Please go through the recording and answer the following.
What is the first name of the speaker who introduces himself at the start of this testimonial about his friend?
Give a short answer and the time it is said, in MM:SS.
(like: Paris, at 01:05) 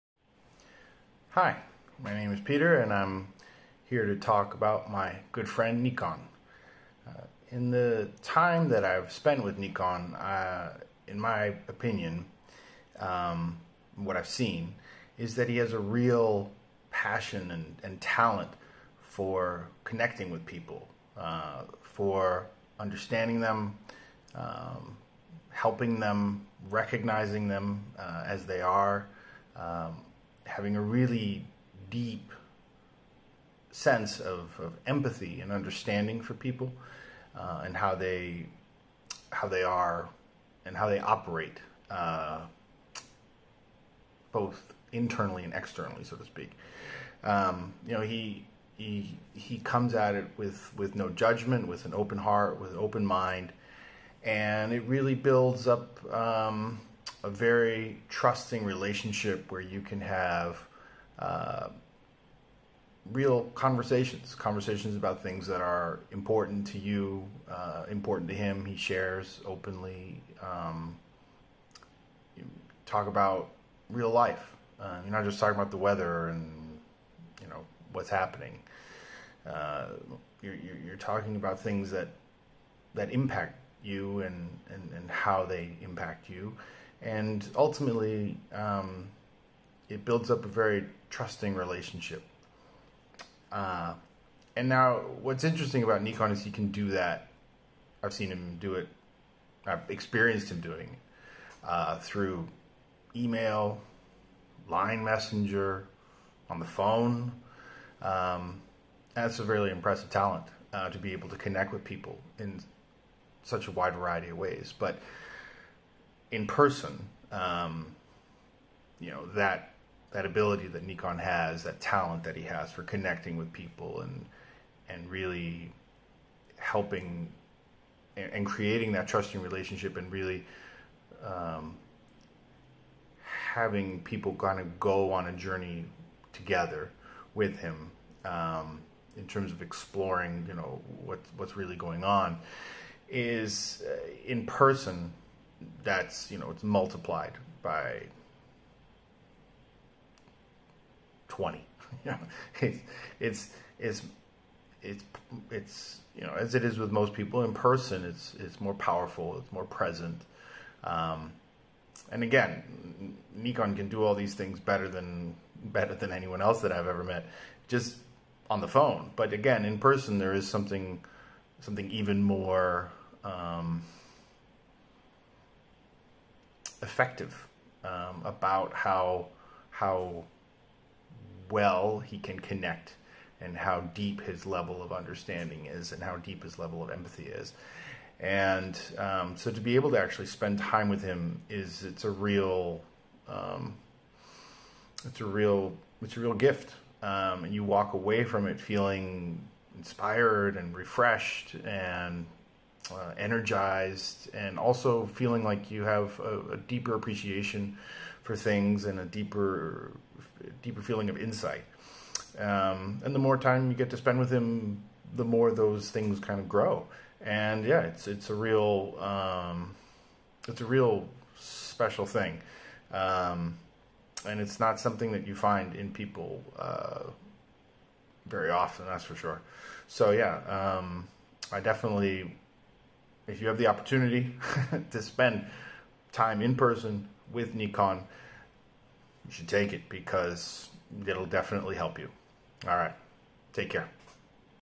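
Peter, at 00:02.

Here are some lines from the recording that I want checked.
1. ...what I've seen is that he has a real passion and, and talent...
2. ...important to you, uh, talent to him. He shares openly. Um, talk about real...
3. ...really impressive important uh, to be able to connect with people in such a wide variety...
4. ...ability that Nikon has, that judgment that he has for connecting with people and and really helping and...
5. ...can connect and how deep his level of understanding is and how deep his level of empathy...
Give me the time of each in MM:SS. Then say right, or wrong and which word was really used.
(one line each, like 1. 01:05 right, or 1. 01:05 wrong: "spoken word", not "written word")
1. 00:13 right
2. 01:06 wrong: "important", not "talent"
3. 01:49 wrong: "talent", not "important"
4. 02:00 wrong: "talent", not "judgment"
5. 03:02 right.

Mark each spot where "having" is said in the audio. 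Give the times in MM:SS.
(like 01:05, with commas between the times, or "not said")
00:30, 02:13.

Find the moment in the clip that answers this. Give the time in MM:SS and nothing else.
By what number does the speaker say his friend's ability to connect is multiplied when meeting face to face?
02:31.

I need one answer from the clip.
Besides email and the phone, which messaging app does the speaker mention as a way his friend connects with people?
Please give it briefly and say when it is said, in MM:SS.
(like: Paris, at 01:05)
Line messenger, at 01:44.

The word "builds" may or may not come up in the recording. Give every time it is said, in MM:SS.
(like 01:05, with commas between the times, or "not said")
00:55, 01:30.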